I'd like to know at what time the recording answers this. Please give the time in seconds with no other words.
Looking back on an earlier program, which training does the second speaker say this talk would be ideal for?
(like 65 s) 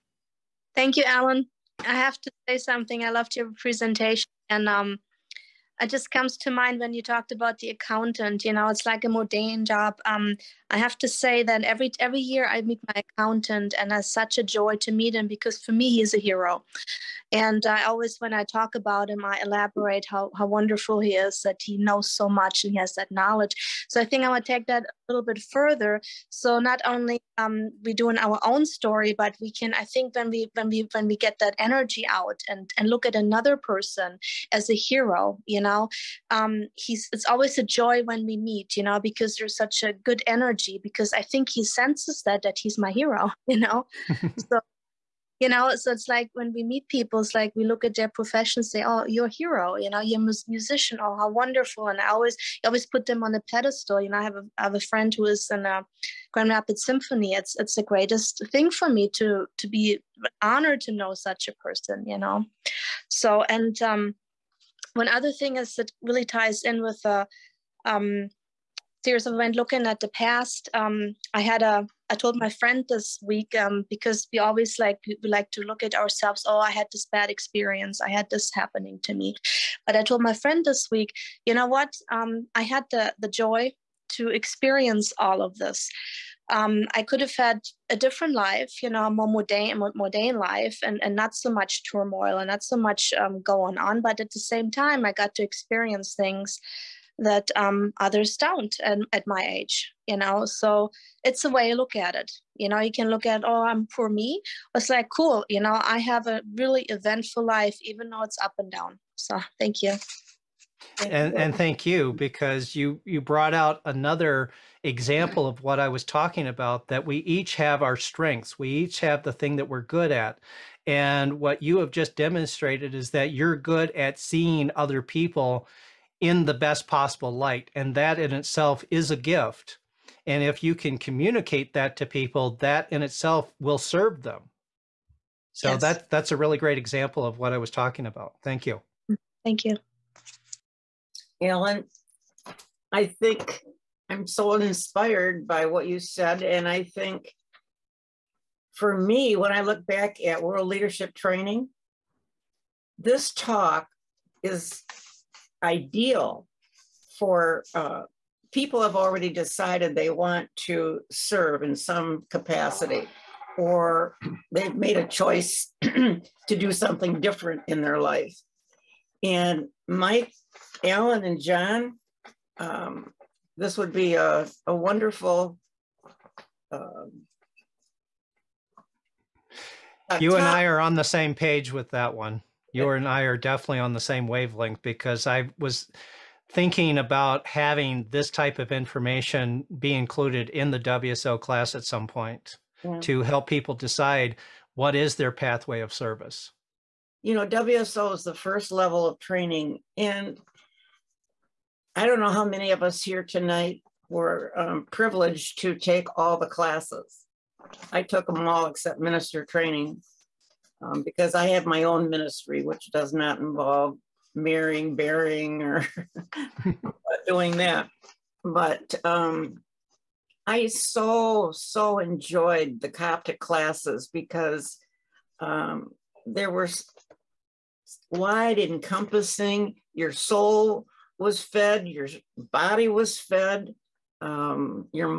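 150 s.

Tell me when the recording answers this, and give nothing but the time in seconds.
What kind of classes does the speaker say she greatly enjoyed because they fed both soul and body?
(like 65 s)
222 s.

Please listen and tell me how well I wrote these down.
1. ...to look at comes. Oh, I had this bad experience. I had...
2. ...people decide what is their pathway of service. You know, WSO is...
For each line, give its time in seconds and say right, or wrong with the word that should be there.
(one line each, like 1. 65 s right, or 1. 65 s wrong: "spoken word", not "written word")
1. 75 s wrong: "ourselves", not "comes"
2. 193 s right.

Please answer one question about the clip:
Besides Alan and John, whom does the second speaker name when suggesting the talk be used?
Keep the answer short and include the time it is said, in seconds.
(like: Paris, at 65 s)
Mike, at 169 s.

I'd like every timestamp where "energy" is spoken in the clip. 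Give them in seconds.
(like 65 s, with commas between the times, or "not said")
31 s, 40 s.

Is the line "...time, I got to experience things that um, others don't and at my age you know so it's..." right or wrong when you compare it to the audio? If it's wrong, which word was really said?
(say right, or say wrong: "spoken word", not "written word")
right.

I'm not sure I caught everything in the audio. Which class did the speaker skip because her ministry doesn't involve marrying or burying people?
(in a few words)
minister training.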